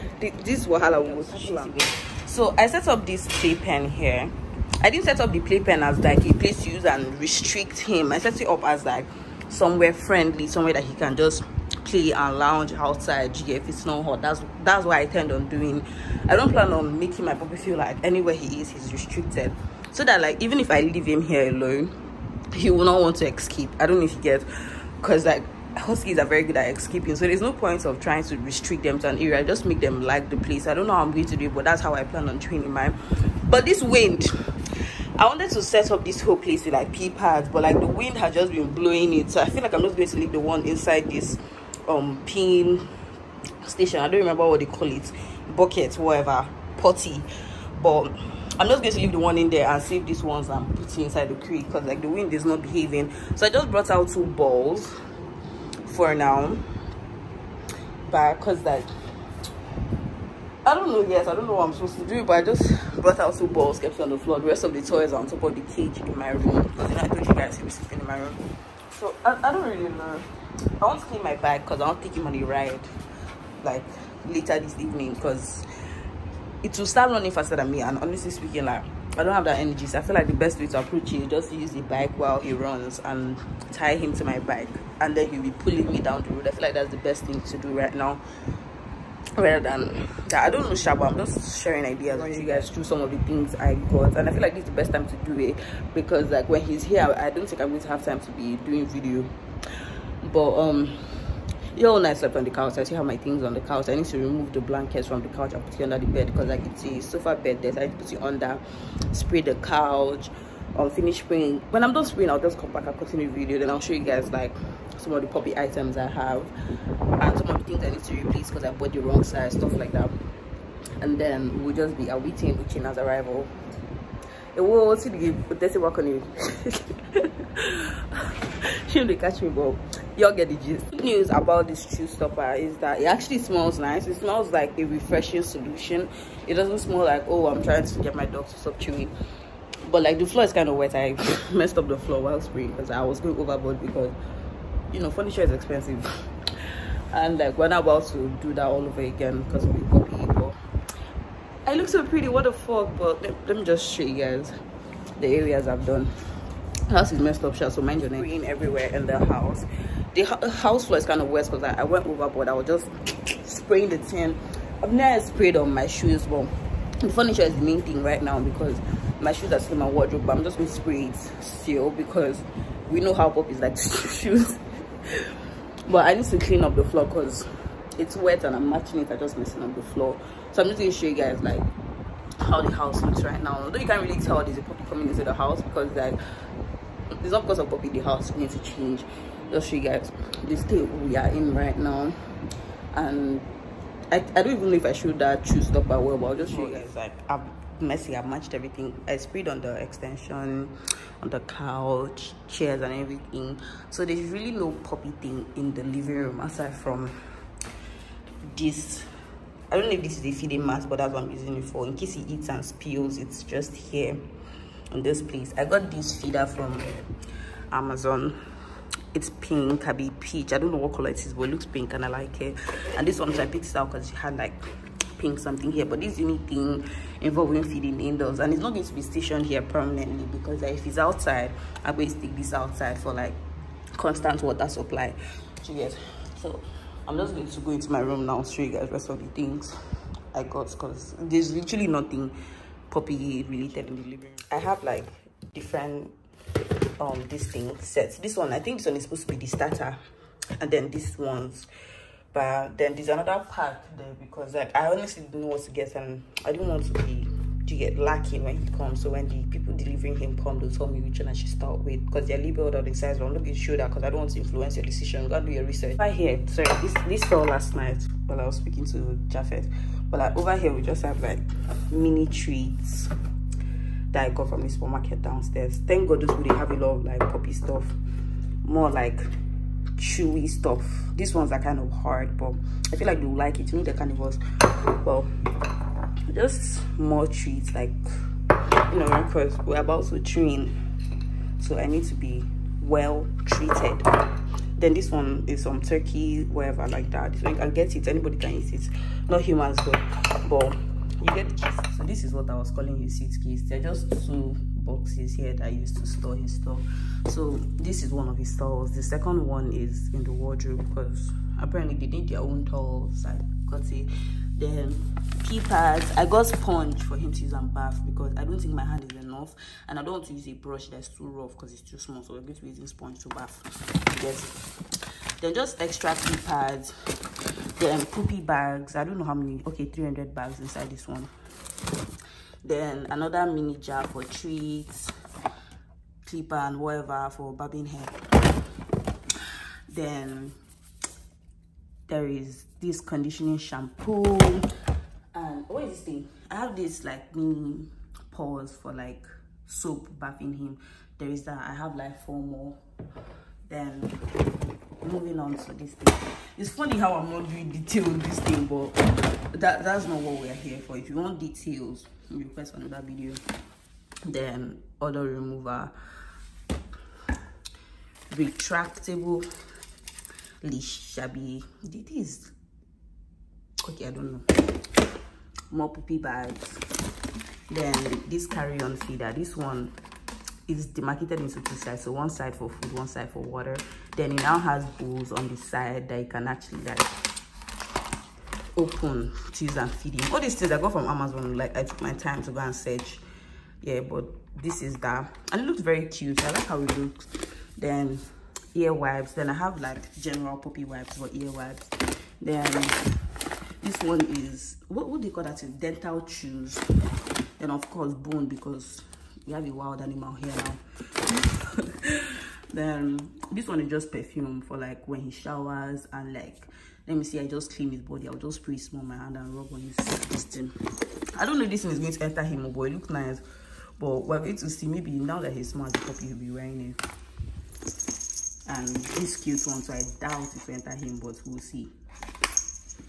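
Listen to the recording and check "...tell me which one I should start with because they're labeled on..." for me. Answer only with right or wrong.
right.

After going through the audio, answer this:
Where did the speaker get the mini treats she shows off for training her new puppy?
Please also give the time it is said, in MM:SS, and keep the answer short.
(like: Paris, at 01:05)
The supermarket downstairs, at 04:34.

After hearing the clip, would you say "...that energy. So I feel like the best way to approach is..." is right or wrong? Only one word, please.
right.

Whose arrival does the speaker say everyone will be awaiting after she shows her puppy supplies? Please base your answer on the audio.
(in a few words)
Uchenna.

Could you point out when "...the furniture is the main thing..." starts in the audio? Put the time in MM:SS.
02:46.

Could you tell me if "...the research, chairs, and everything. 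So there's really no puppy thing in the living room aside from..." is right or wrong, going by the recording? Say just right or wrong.
wrong.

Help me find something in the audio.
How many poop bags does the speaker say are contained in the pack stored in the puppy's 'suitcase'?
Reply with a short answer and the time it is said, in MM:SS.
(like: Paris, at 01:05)
300, at 05:29.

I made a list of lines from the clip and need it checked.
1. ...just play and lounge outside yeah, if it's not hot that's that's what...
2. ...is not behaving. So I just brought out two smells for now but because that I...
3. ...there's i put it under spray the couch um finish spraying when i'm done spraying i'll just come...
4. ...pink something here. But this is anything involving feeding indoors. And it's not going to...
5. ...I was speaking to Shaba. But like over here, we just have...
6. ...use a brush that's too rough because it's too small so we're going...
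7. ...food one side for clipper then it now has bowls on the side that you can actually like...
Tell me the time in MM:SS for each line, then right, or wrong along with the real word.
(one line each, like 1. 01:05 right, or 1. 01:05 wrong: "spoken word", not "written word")
1. 00:11 right
2. 00:52 wrong: "balls", not "smells"
3. 01:47 right
4. 03:45 right
5. 04:28 wrong: "Jafet", not "Shaba"
6. 05:20 right
7. 06:22 wrong: "water", not "clipper".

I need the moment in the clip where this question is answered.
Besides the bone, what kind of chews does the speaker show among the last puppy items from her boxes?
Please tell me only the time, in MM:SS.
06:45.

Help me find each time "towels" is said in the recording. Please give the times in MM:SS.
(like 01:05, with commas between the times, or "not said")
05:08, 05:12.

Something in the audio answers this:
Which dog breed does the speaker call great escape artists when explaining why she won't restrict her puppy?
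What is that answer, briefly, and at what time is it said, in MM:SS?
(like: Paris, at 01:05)
Huskies, at 00:25.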